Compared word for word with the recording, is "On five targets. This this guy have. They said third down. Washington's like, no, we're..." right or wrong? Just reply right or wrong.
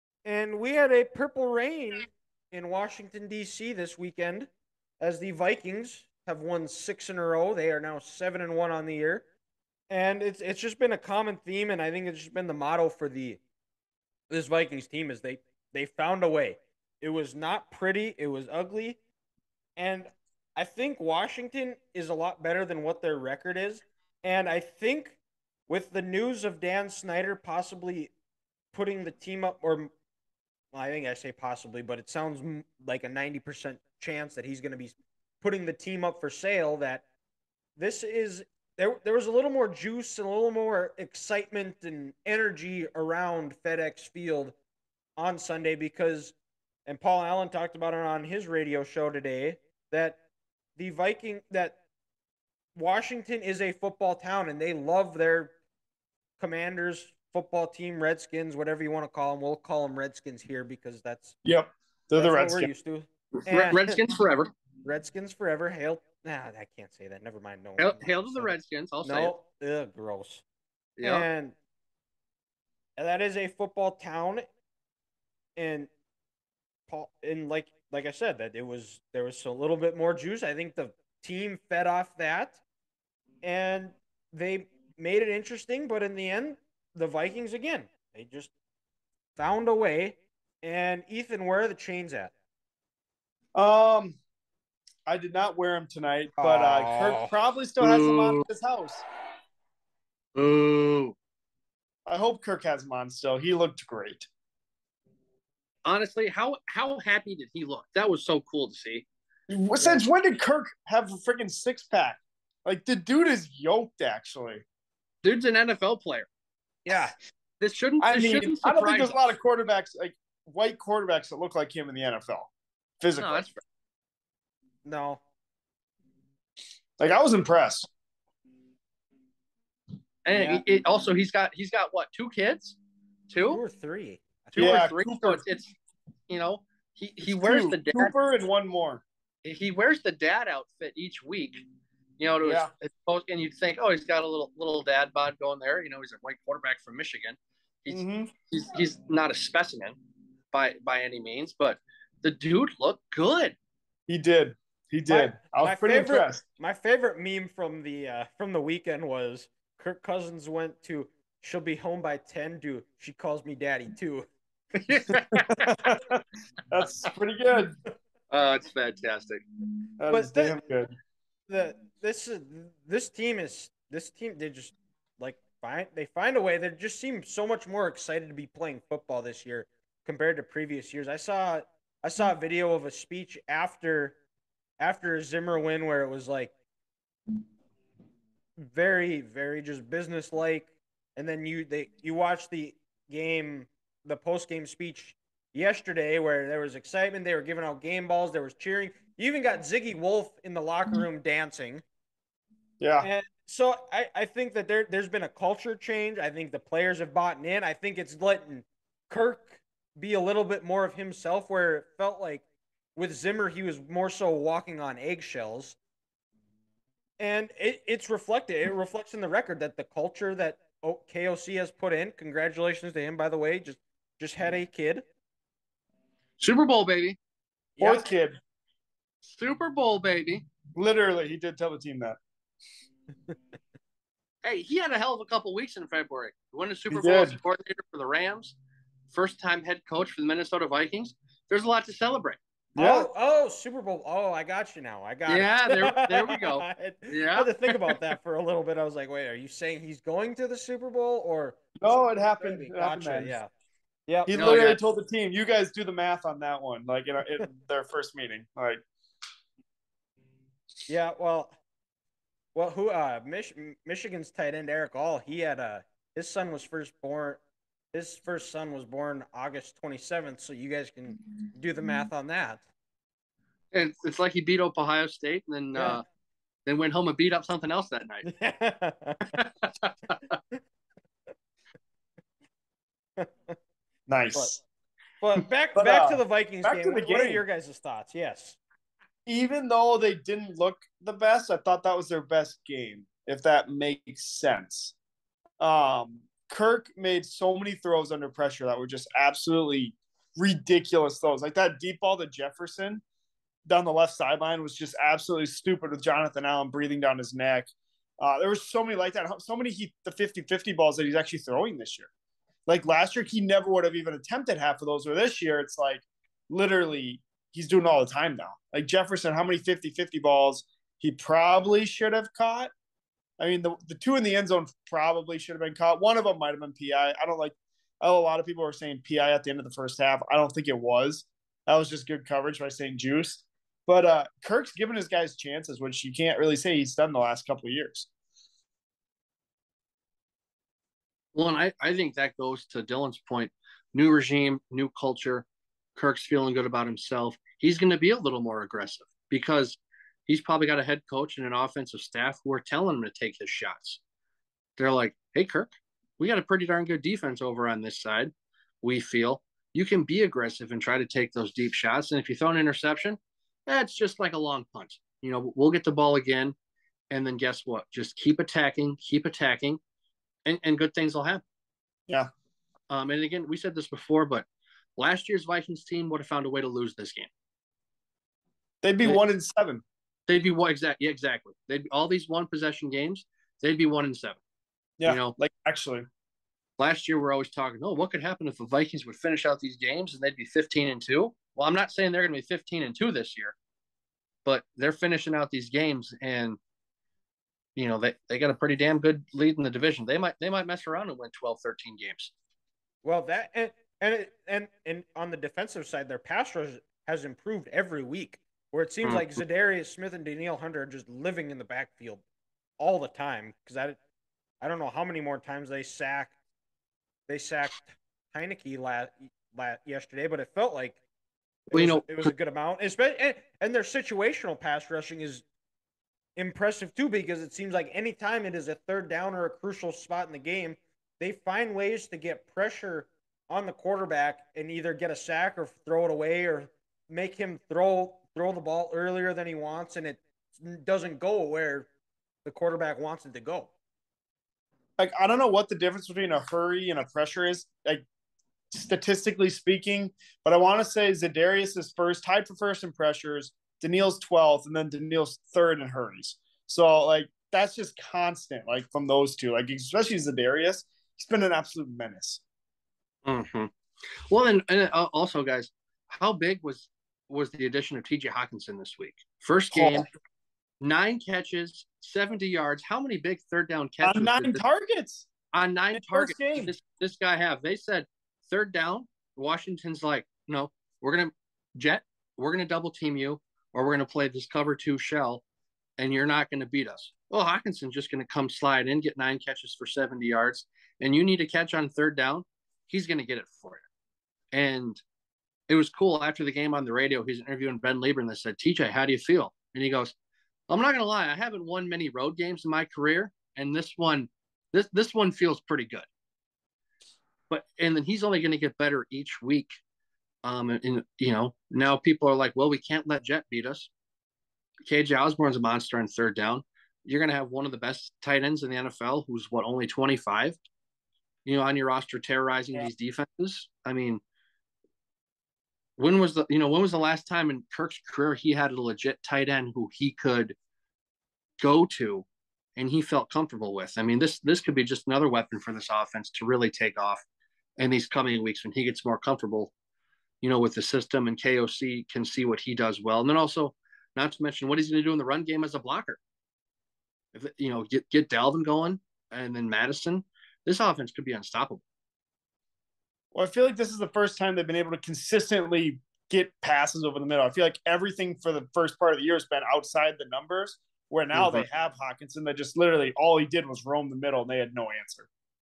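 wrong.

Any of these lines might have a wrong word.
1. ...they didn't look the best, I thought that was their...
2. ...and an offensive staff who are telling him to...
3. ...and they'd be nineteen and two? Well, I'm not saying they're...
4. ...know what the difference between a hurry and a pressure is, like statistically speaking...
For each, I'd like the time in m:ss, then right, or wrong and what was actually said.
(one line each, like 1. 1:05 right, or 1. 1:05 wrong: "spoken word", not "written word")
1. 4:49 right
2. 5:51 right
3. 6:30 wrong: "fifteen", not "nineteen"
4. 7:25 right.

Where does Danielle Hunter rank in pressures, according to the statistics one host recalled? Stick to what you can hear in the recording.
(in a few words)
12th.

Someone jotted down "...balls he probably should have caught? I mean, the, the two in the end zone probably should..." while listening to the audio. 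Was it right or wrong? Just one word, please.
right.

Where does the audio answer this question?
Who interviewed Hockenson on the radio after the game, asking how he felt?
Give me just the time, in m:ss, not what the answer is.
8:17.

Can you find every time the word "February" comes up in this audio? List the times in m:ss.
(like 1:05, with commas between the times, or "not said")
3:55.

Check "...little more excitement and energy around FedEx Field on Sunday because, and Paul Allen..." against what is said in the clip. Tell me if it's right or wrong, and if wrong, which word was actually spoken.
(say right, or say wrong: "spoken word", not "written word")
right.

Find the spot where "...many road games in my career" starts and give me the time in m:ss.
8:21.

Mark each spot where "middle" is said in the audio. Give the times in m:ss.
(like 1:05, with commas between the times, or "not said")
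9:17, 9:24.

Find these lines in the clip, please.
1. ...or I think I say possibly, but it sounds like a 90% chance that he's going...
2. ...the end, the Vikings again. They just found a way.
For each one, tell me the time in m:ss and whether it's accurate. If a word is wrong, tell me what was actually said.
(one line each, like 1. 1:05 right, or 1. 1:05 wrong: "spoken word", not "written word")
1. 0:29 right
2. 1:26 right.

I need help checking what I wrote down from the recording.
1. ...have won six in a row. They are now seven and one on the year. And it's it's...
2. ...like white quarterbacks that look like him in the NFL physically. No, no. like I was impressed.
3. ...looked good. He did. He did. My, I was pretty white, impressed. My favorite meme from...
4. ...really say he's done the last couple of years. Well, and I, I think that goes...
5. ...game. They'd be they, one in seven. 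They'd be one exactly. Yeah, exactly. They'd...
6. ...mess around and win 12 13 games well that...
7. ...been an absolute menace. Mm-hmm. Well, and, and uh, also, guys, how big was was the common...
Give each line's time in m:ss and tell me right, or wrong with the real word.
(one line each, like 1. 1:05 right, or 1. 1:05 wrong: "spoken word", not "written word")
1. 0:06 right
2. 1:59 right
3. 2:32 wrong: "favorite", not "white"
4. 5:36 right
5. 6:17 right
6. 6:40 right
7. 7:41 wrong: "addition", not "common".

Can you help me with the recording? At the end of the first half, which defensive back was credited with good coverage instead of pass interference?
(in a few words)
St-Juste.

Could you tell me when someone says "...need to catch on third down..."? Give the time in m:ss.
8:11.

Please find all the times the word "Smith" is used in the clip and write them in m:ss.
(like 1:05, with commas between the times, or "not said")
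6:49.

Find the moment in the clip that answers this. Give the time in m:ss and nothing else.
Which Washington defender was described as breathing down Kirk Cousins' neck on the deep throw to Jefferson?
5:06.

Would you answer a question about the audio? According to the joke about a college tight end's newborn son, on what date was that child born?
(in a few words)
August 27th.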